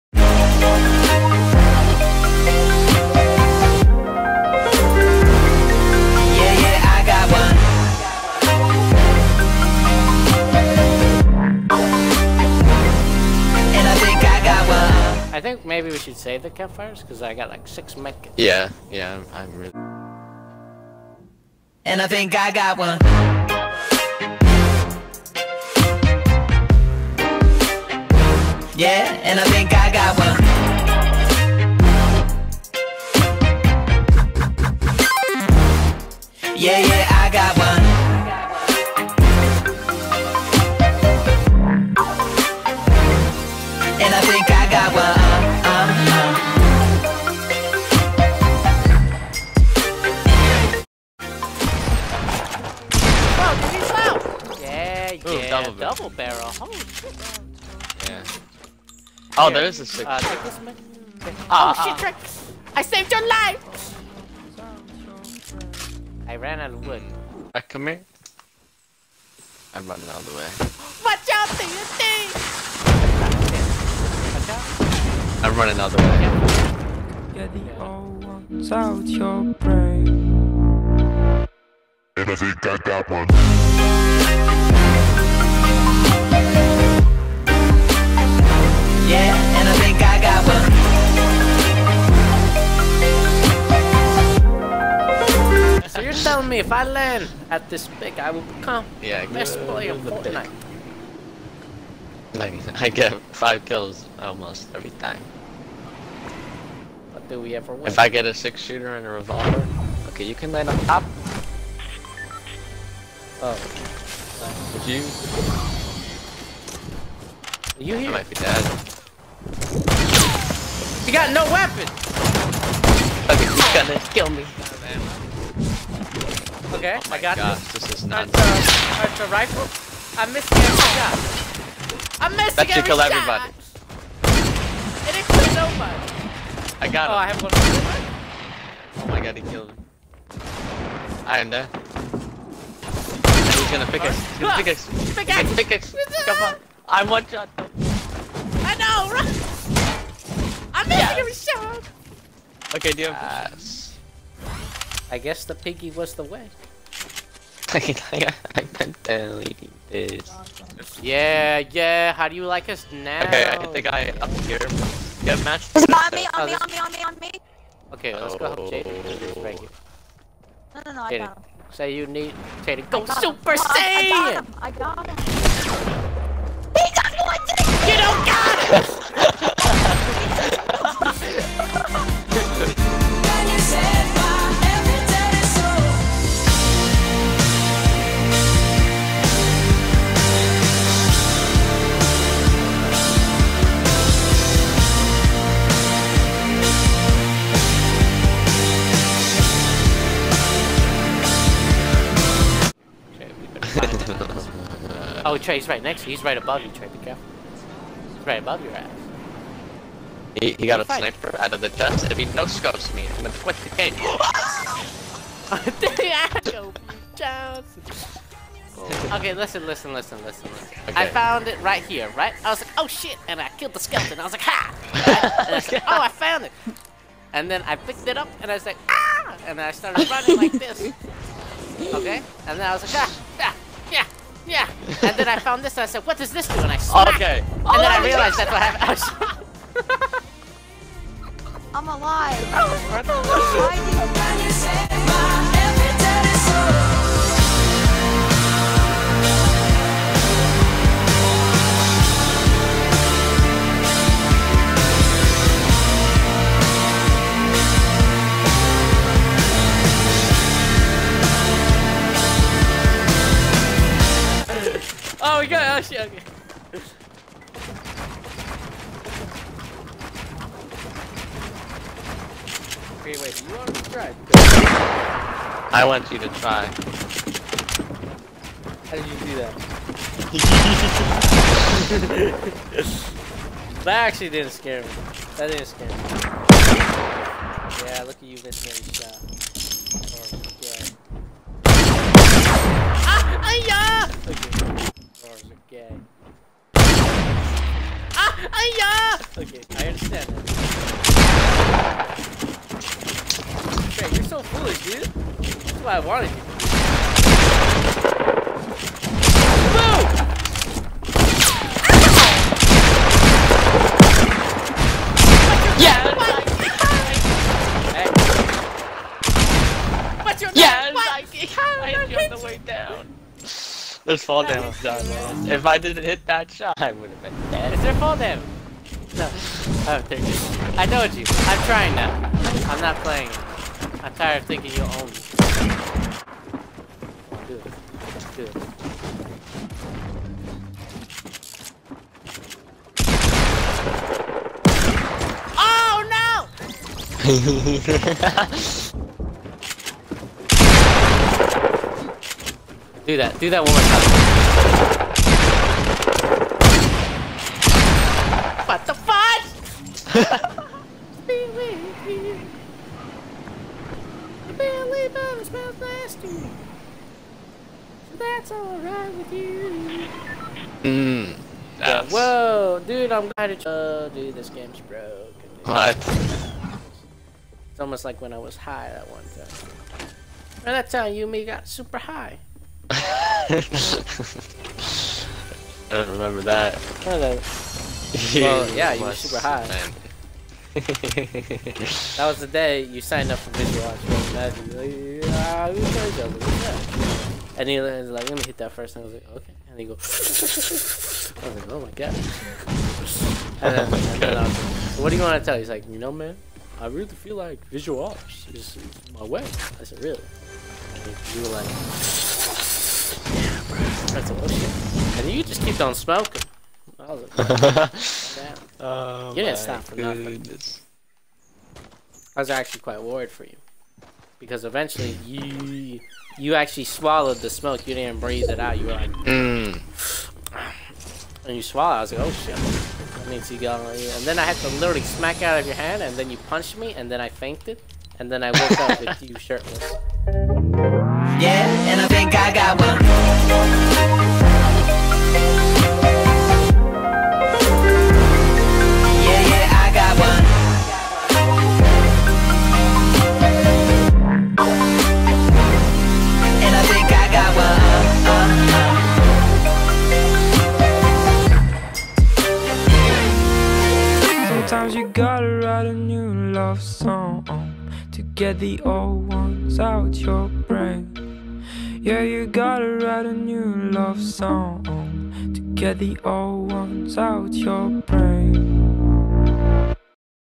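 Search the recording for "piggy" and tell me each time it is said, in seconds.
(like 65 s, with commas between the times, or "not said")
155 s.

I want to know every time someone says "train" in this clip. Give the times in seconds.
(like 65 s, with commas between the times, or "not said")
not said.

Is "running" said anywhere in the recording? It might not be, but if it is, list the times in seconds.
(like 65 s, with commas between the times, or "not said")
69 s, 75 s, 230 s.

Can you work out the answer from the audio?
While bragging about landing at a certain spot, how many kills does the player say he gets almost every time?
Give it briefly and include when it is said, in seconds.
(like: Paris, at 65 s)
5, at 103 s.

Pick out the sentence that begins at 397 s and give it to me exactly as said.
And he was like, let me hit that first.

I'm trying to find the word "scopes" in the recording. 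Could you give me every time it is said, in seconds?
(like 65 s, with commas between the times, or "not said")
212 s.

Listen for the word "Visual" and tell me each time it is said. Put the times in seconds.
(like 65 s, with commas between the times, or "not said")
407 s.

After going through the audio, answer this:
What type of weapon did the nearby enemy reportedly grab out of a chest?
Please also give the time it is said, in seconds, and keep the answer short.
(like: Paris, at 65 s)
Sniper, at 210 s.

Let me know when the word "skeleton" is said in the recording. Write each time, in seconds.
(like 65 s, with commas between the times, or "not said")
223 s.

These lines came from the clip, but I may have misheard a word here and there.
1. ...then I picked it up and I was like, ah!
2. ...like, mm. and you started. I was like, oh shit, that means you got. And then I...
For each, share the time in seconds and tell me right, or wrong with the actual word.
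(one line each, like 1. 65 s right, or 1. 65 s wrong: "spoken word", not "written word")
1. 227 s right
2. 428 s wrong: "swallowed", not "started".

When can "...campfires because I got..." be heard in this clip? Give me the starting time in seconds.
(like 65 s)
16 s.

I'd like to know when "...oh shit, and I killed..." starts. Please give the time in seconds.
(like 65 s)
222 s.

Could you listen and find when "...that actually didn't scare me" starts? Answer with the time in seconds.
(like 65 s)
283 s.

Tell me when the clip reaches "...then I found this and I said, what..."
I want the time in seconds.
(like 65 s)
235 s.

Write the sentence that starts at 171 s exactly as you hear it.
Say you need Jaden Go Super Saiyan!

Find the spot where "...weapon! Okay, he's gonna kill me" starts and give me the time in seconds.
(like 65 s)
121 s.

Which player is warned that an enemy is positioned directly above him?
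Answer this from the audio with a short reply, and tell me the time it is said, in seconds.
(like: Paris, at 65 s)
Trey, at 206 s.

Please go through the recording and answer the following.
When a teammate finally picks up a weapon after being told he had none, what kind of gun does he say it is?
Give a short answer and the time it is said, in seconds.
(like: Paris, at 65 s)
Rifle, at 129 s.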